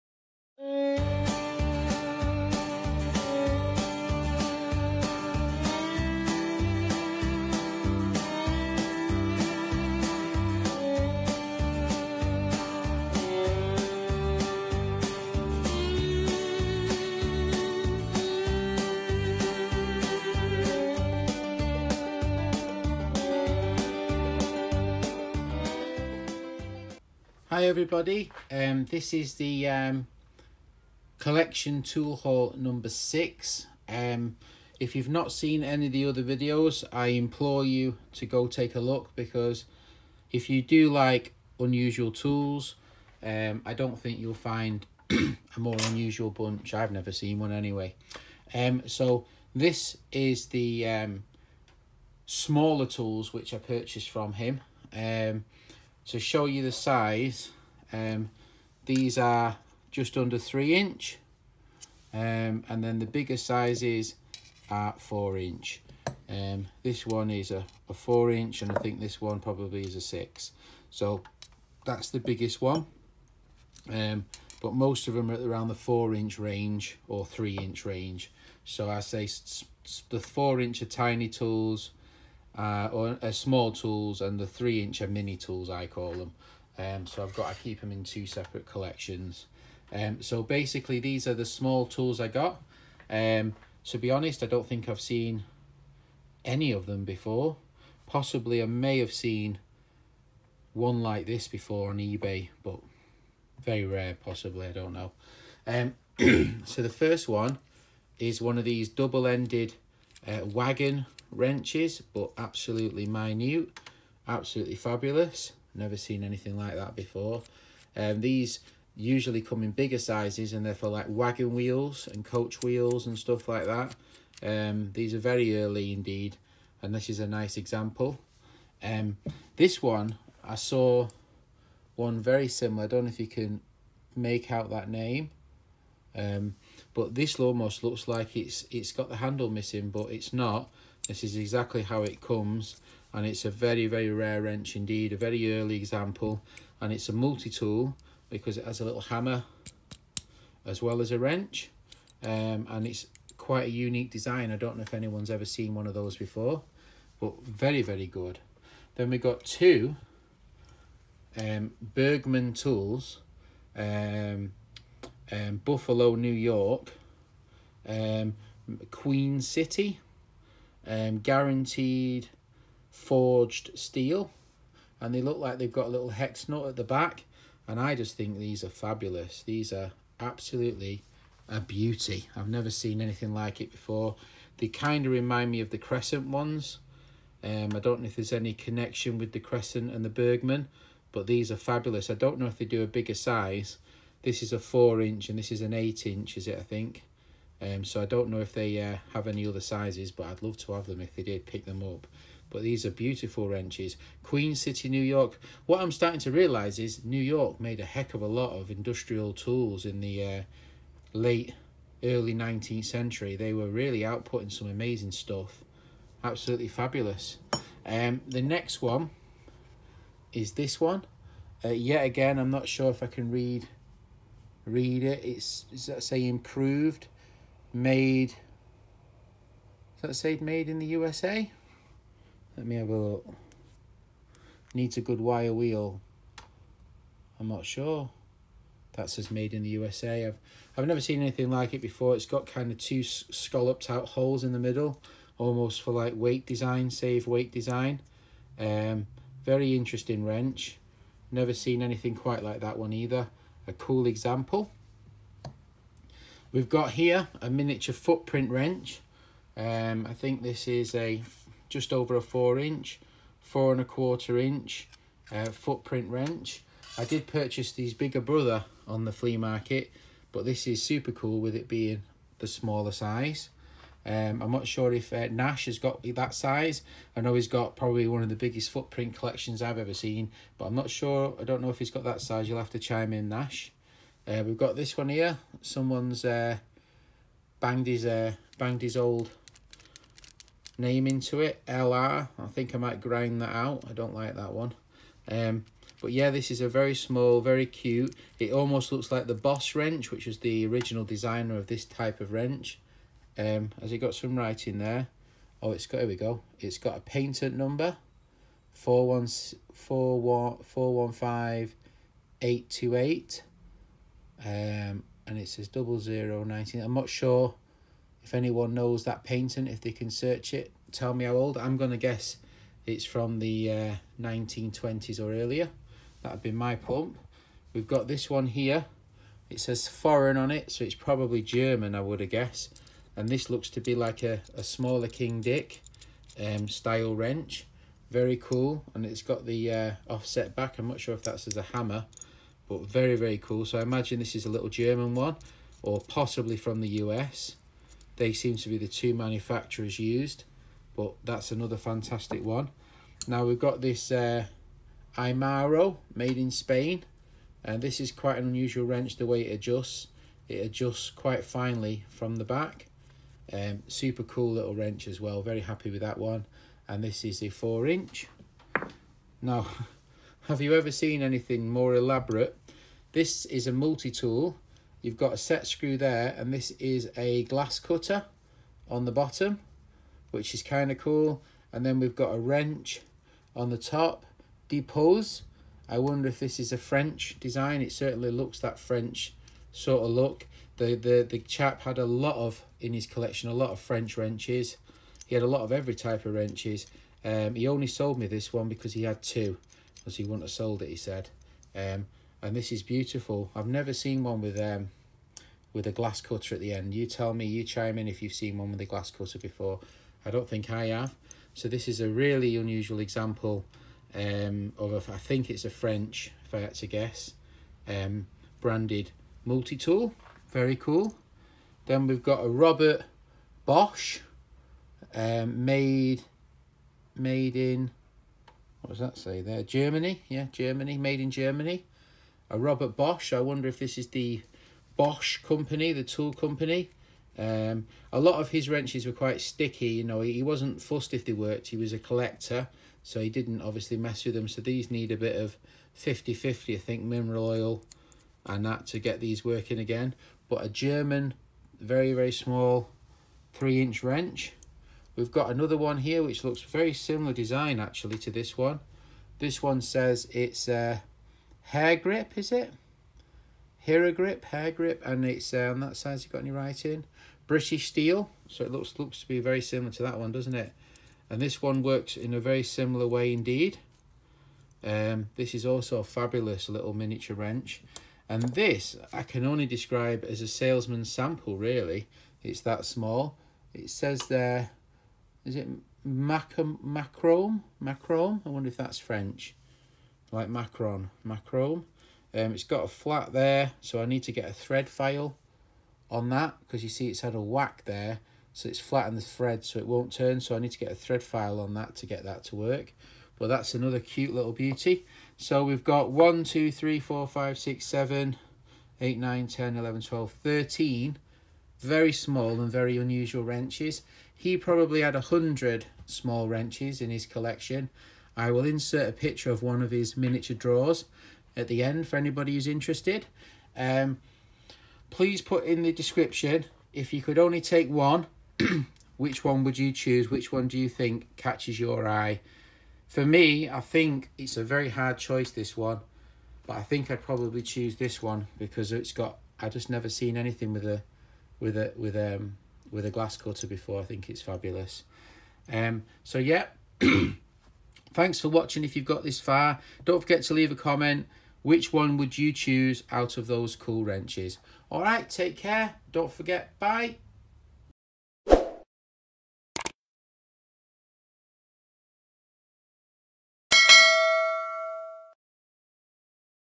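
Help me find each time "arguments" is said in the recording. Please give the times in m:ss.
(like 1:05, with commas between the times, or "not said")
not said.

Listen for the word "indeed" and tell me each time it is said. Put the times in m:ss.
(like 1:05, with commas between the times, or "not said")
2:05, 2:24, 7:53.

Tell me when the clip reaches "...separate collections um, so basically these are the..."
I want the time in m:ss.
1:28.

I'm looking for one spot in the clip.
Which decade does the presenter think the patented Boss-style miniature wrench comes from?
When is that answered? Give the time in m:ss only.
5:24.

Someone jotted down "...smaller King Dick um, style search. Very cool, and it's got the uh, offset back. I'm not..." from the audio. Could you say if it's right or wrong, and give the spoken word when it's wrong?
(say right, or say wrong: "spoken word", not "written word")
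wrong: "wrench", not "search".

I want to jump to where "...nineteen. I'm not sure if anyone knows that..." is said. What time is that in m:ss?
5:16.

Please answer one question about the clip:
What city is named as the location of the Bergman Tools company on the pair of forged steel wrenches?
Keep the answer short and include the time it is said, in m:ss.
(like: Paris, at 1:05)
Buffalo, New York, at 2:45.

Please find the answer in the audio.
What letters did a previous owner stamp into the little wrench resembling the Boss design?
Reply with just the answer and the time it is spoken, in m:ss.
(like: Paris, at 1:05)
LR, at 4:51.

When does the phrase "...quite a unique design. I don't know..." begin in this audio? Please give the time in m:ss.
2:33.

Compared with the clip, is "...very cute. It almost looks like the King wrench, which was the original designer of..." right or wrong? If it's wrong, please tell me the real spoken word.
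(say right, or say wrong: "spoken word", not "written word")
wrong: "Boss", not "King".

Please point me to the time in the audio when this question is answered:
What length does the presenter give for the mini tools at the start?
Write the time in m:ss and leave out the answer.
0:59.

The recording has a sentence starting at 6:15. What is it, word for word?
You've got a set screw there and this is a glass cutter on the bottom, which is kind of cool.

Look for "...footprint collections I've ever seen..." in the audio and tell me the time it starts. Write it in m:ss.
4:38.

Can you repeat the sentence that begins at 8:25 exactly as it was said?
So we've got 1, 2, 3, 4, 5, 6, 7, 8, 9, 10, 11, 12, 13 very small and very unusual wrenches.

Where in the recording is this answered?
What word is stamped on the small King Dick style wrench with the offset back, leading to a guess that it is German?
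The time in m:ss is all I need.
5:29.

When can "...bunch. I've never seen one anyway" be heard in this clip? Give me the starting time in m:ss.
0:46.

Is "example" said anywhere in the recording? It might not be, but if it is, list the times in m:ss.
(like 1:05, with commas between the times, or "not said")
2:07, 2:25, 4:14, 6:52.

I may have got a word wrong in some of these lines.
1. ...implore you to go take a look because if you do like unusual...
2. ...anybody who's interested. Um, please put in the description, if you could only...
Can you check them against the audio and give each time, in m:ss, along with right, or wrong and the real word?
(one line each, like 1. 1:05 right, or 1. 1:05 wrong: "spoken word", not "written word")
1. 0:37 right
2. 8:42 right.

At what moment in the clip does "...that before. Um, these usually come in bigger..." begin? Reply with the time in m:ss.
1:56.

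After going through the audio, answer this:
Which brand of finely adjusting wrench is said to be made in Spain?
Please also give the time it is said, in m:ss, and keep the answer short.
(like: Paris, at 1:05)
Irimo, at 5:55.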